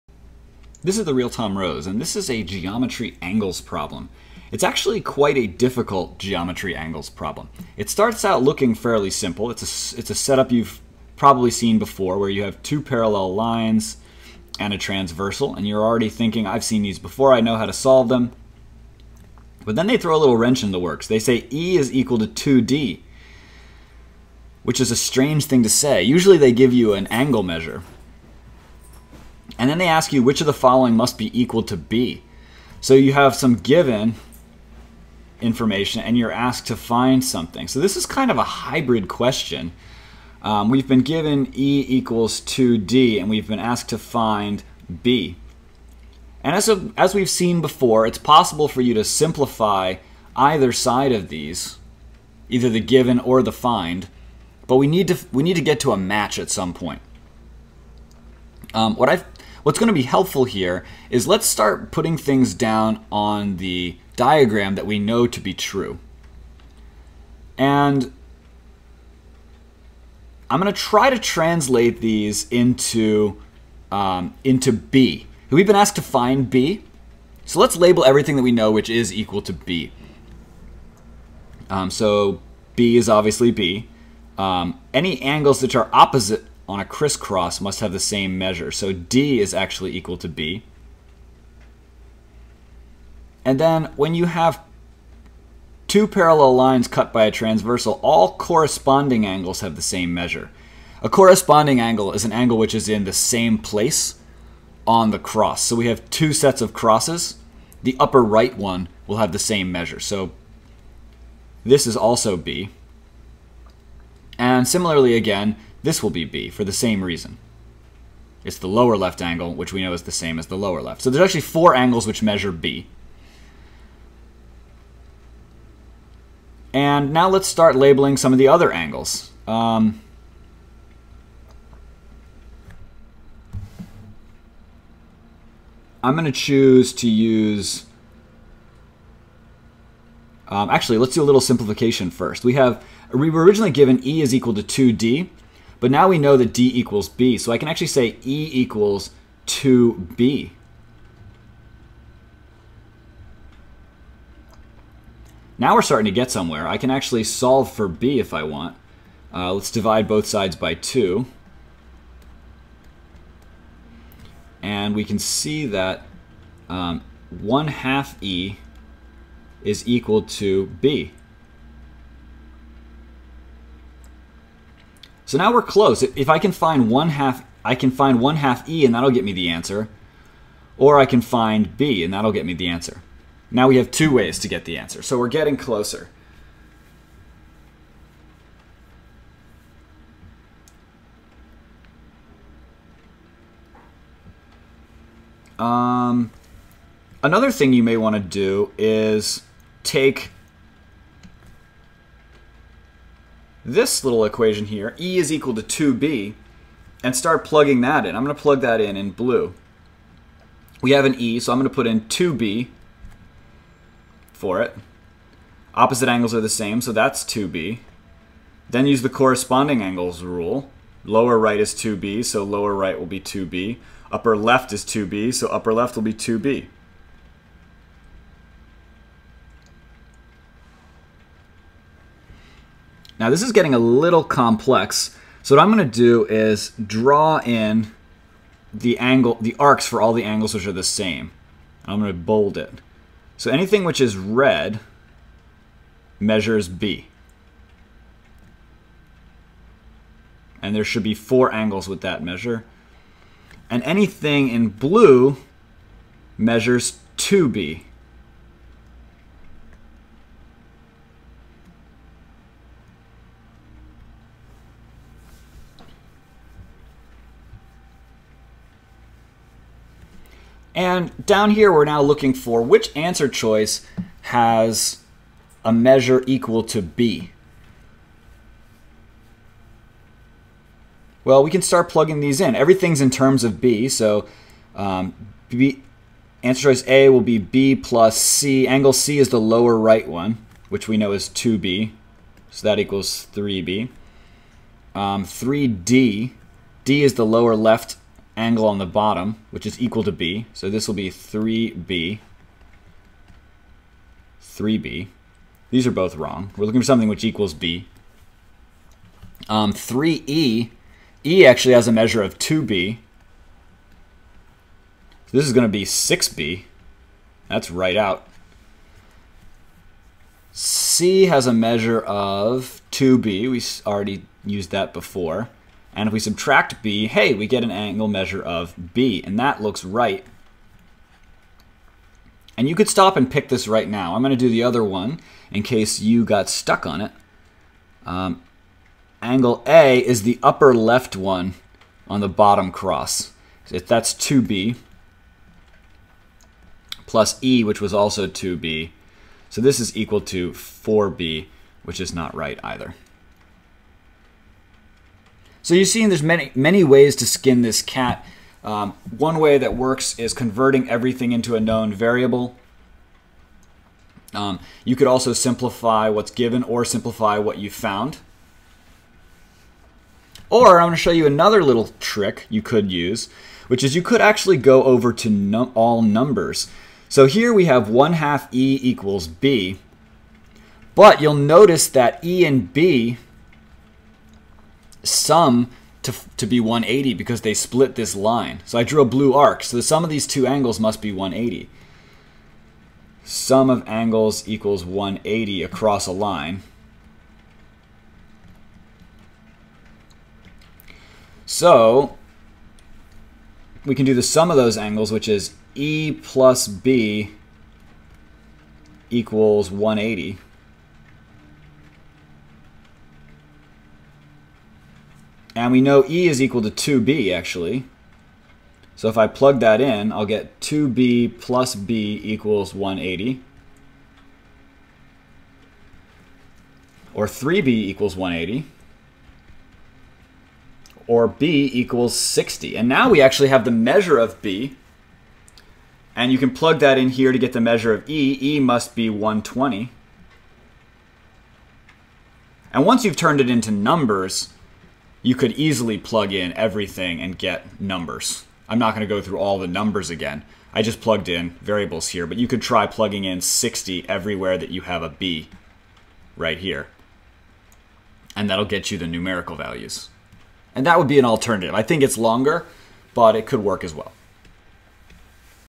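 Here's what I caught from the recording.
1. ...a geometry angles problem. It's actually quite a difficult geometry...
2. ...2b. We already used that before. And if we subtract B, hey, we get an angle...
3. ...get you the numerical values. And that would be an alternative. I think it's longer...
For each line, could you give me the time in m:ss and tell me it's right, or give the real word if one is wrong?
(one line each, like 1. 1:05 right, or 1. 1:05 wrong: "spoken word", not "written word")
1. 0:02 right
2. 5:22 right
3. 7:38 right.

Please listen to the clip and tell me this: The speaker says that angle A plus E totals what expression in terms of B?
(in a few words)
4B.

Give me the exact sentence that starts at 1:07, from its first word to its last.
And I'm going to try to translate these into, um, into B.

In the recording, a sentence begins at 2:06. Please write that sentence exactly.
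And now let's start labeling some of the other angles.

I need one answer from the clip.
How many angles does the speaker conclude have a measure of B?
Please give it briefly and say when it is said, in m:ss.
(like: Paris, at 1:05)
4, at 2:01.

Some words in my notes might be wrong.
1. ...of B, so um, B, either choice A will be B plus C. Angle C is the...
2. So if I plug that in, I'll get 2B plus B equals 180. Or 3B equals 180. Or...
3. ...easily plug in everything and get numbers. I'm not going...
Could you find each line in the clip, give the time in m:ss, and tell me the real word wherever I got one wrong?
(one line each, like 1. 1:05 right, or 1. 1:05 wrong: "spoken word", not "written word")
1. 4:43 wrong: "answer", not "either"
2. 6:58 right
3. 7:25 right.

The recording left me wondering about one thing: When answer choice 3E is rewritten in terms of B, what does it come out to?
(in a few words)
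6B.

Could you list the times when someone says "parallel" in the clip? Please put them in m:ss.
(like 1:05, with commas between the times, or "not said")
0:12, 1:36.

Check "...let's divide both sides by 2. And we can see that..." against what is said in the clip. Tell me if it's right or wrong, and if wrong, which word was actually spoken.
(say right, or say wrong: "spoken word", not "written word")
right.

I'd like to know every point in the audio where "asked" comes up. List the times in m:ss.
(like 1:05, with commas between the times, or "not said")
0:36, 0:43, 1:15.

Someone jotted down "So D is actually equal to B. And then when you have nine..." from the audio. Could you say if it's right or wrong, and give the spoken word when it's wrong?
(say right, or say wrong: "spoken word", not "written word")
wrong: "two", not "nine".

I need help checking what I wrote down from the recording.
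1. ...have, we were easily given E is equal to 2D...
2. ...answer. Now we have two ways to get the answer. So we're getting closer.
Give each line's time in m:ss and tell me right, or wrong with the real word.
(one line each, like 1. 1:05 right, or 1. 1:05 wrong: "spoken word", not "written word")
1. 2:22 wrong: "originally", not "easily"
2. 3:02 right.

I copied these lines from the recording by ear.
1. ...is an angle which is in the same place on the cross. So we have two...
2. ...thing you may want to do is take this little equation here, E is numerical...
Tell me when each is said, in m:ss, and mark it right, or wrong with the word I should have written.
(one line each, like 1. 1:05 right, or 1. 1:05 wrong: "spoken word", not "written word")
1. 1:42 right
2. 3:17 wrong: "equal", not "numerical".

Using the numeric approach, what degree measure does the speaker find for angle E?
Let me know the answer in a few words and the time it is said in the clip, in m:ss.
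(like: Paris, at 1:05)
120, at 7:18.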